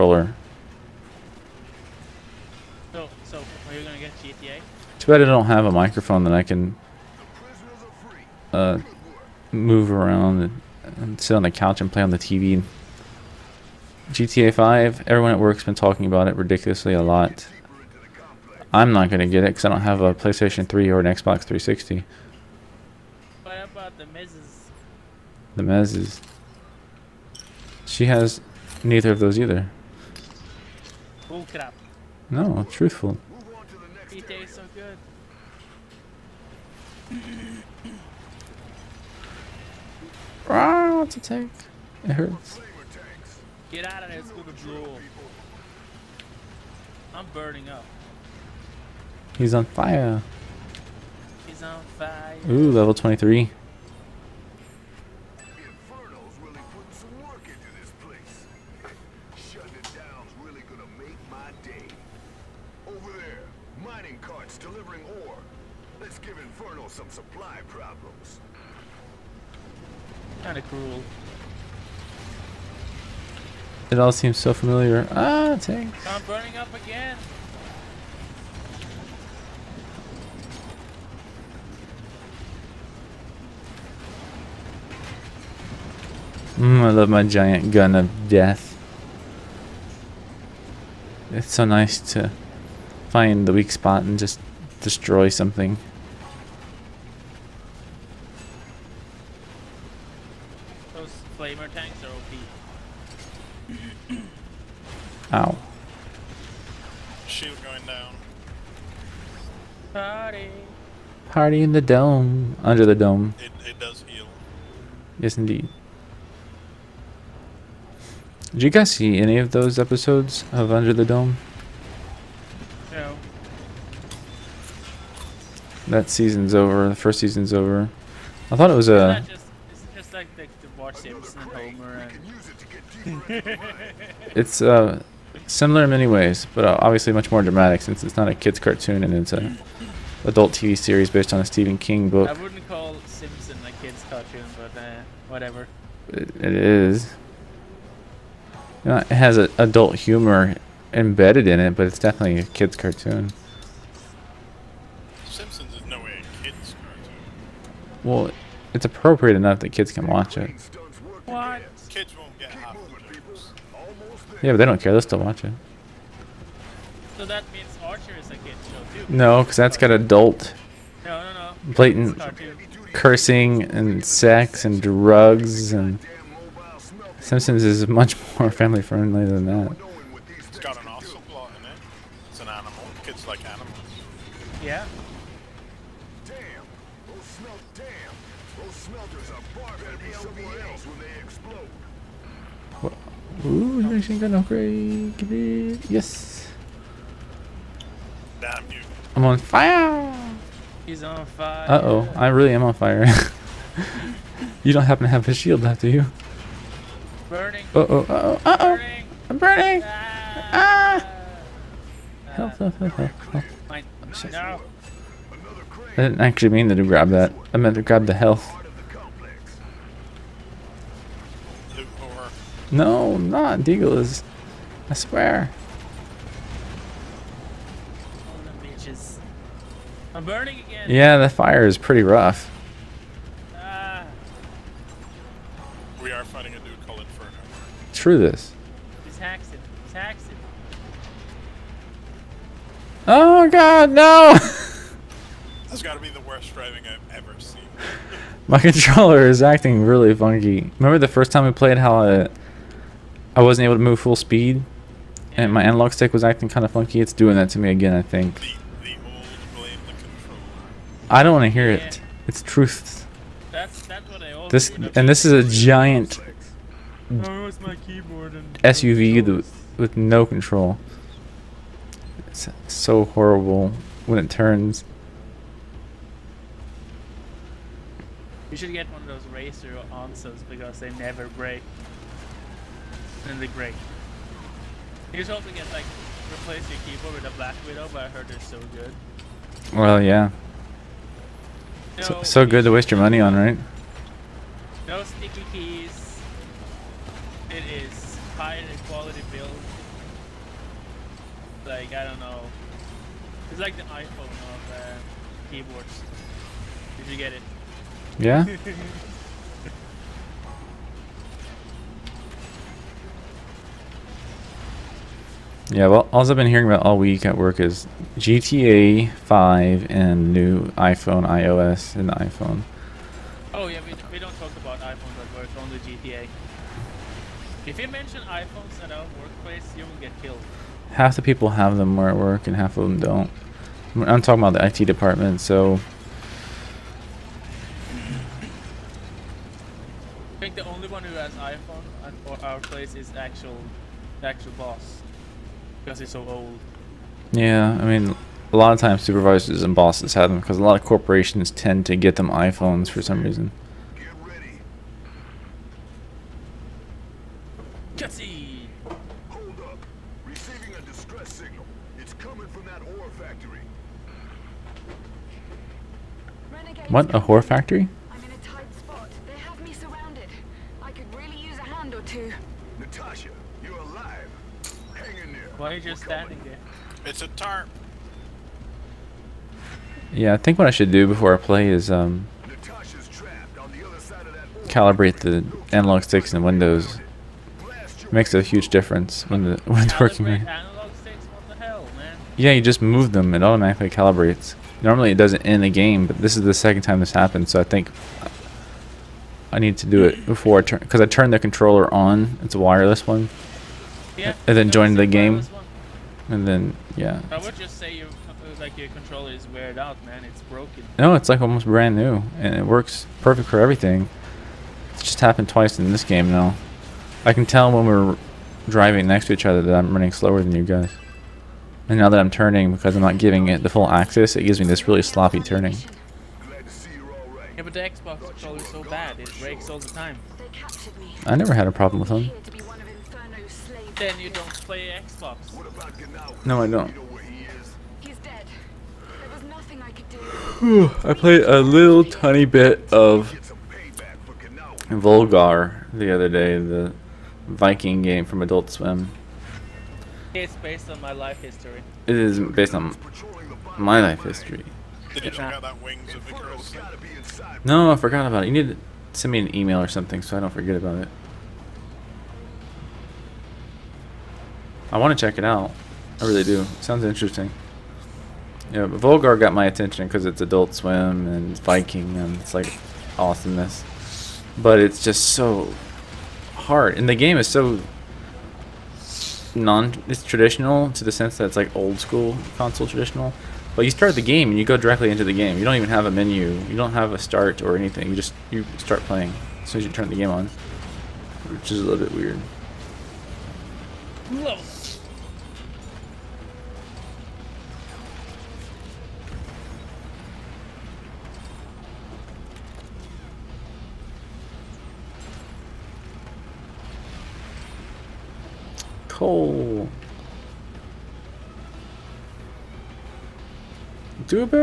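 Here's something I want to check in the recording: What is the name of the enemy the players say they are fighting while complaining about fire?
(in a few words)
Inferno.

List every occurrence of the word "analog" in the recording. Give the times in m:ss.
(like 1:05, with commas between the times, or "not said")
4:15, 6:25.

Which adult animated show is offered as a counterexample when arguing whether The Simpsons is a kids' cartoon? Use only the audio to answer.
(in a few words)
Archer.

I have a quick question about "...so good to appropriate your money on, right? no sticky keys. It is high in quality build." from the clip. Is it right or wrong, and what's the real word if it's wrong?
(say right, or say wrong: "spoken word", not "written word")
wrong: "waste", not "appropriate".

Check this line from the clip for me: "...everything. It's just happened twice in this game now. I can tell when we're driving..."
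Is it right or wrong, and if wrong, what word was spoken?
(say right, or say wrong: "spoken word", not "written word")
right.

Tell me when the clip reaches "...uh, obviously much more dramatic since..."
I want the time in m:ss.
2:16.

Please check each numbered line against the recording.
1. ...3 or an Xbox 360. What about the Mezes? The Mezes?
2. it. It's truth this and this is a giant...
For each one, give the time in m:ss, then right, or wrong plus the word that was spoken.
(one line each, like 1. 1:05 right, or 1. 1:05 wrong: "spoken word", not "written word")
1. 0:20 right
2. 4:21 right.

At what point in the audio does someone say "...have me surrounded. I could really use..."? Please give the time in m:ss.
6:09.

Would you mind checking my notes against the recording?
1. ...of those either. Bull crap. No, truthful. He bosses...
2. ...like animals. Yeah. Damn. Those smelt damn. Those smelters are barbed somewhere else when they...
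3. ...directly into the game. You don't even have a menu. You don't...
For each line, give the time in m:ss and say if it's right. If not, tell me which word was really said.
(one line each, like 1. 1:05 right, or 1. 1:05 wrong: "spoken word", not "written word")
1. 0:29 wrong: "tastes", not "bosses"
2. 3:03 right
3. 8:04 right.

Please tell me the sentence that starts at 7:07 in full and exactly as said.
Yeah, but the Xbox so bad, it breaks all the time.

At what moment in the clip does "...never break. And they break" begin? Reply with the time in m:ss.
4:40.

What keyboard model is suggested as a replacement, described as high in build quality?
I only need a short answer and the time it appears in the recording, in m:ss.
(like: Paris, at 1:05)
Black Widow, at 4:47.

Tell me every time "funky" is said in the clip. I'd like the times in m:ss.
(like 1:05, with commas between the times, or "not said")
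4:10, 4:16.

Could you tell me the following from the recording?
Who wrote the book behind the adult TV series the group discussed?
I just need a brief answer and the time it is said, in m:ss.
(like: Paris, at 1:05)
Stephen King, at 2:21.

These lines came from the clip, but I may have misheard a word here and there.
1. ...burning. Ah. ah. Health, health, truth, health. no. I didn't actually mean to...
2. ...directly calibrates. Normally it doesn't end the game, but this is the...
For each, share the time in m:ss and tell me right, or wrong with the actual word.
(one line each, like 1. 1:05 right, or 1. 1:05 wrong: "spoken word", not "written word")
1. 3:29 wrong: "health", not "truth"
2. 6:33 wrong: "automatically", not "directly".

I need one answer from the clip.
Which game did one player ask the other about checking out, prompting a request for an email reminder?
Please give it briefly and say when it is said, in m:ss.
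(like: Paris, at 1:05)
Wings of Icarus, at 7:35.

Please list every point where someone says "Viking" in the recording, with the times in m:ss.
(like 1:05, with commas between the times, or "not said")
7:27, 7:51.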